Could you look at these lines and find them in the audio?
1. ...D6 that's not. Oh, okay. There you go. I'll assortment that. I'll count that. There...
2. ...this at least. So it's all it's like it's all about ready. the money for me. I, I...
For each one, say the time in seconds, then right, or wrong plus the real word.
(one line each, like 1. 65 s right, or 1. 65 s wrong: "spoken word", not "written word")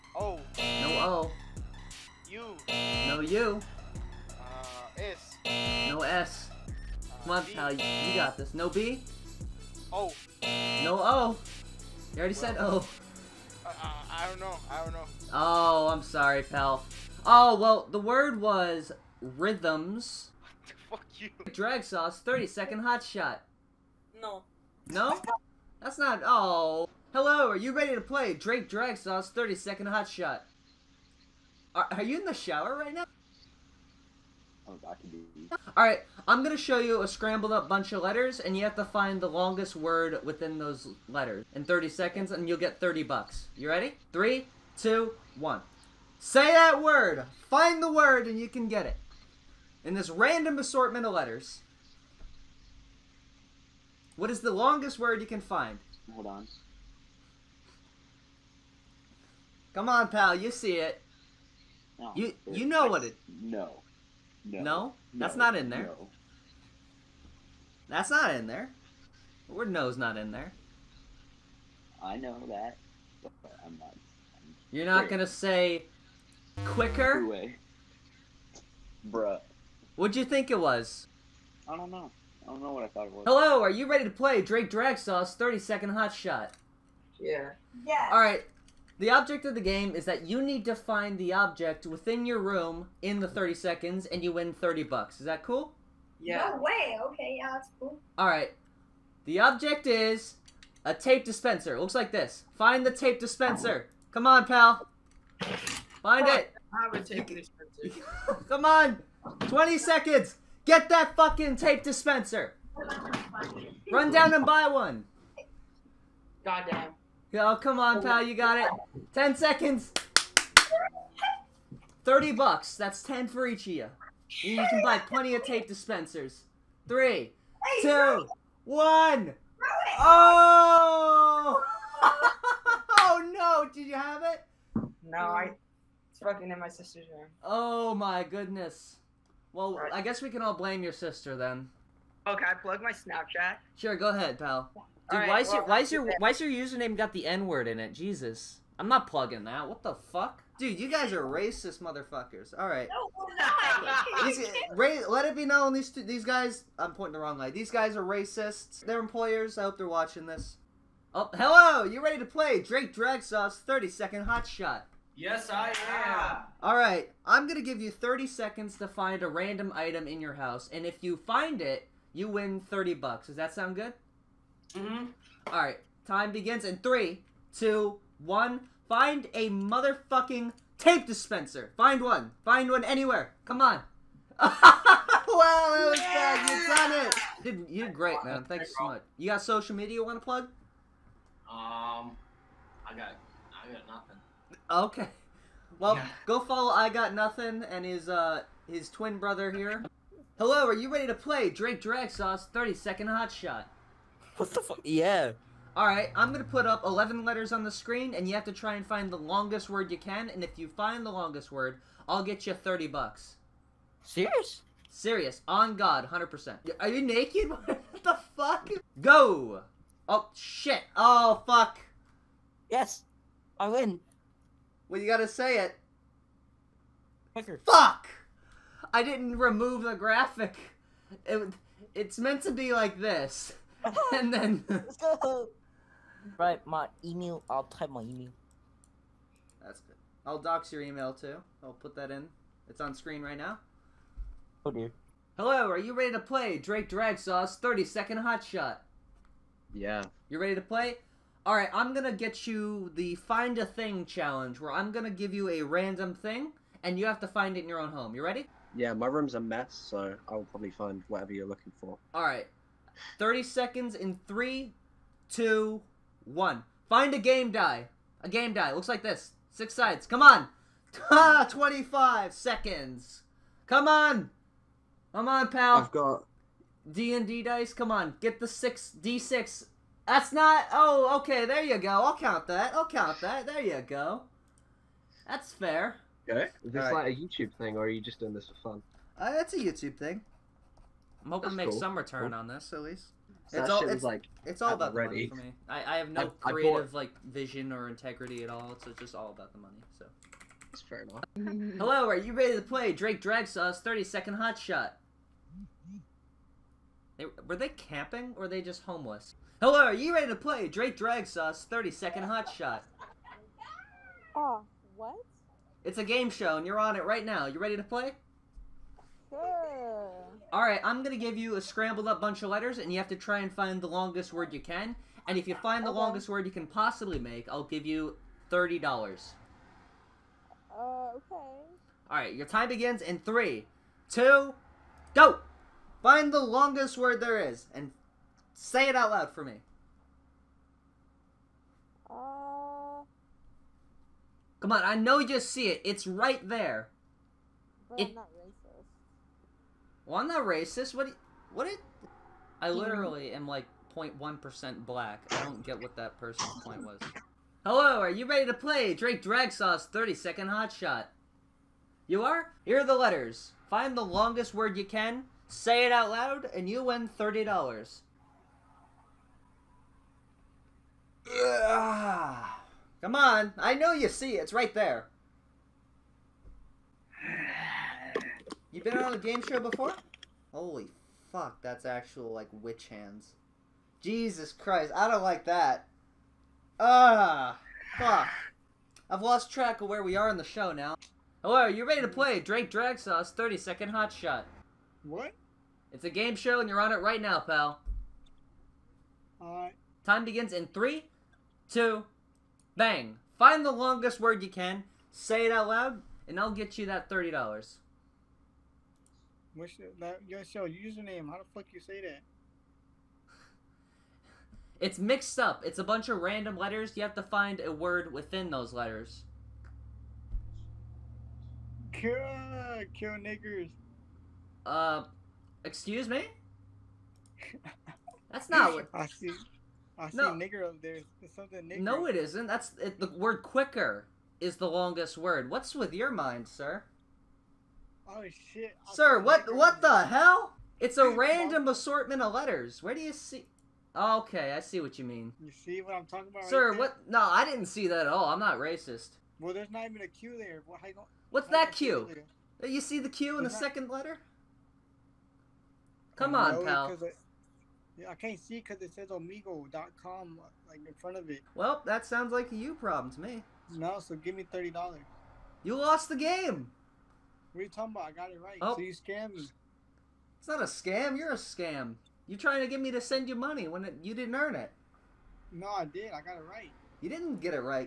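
1. 279 s wrong: "count", not "assortment"
2. 292 s right.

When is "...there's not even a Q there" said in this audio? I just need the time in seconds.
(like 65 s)
449 s.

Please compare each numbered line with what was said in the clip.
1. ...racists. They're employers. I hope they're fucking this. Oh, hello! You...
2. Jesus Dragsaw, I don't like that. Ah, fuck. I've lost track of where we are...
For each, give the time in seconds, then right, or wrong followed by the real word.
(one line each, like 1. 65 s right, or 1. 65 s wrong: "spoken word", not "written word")
1. 158 s wrong: "watching", not "fucking"
2. 384 s wrong: "Christ", not "Dragsaw".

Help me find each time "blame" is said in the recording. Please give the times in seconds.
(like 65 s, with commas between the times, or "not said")
140 s.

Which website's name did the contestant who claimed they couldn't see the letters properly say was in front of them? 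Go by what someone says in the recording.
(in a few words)
omegle.com.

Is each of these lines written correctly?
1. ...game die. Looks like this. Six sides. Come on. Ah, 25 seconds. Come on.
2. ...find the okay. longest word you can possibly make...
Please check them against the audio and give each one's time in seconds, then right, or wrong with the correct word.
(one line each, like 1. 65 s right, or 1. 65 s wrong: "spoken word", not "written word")
1. 268 s right
2. 325 s right.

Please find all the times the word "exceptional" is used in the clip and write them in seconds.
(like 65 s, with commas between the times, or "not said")
not said.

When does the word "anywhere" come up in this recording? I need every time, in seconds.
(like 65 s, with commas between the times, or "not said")
182 s.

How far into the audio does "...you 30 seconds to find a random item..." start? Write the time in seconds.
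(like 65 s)
167 s.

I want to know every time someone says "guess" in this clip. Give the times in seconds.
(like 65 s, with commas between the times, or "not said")
140 s.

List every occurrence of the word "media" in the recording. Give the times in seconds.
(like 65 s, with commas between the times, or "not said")
189 s.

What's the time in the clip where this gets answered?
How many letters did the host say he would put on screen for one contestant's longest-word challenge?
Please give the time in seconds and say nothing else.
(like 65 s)
206 s.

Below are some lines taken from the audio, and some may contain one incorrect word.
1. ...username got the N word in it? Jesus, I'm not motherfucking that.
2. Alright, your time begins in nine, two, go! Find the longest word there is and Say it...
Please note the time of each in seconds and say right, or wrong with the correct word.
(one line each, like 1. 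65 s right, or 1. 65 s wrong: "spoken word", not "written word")
1. 146 s wrong: "plugging", not "motherfucking"
2. 332 s wrong: "three", not "nine".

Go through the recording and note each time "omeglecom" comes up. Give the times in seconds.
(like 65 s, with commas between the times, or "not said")
459 s.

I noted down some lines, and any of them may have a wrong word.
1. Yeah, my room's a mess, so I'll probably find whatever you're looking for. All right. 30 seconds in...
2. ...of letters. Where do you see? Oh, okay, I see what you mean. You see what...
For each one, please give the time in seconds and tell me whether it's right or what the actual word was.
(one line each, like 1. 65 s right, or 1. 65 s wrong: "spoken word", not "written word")
1. 258 s right
2. 442 s right.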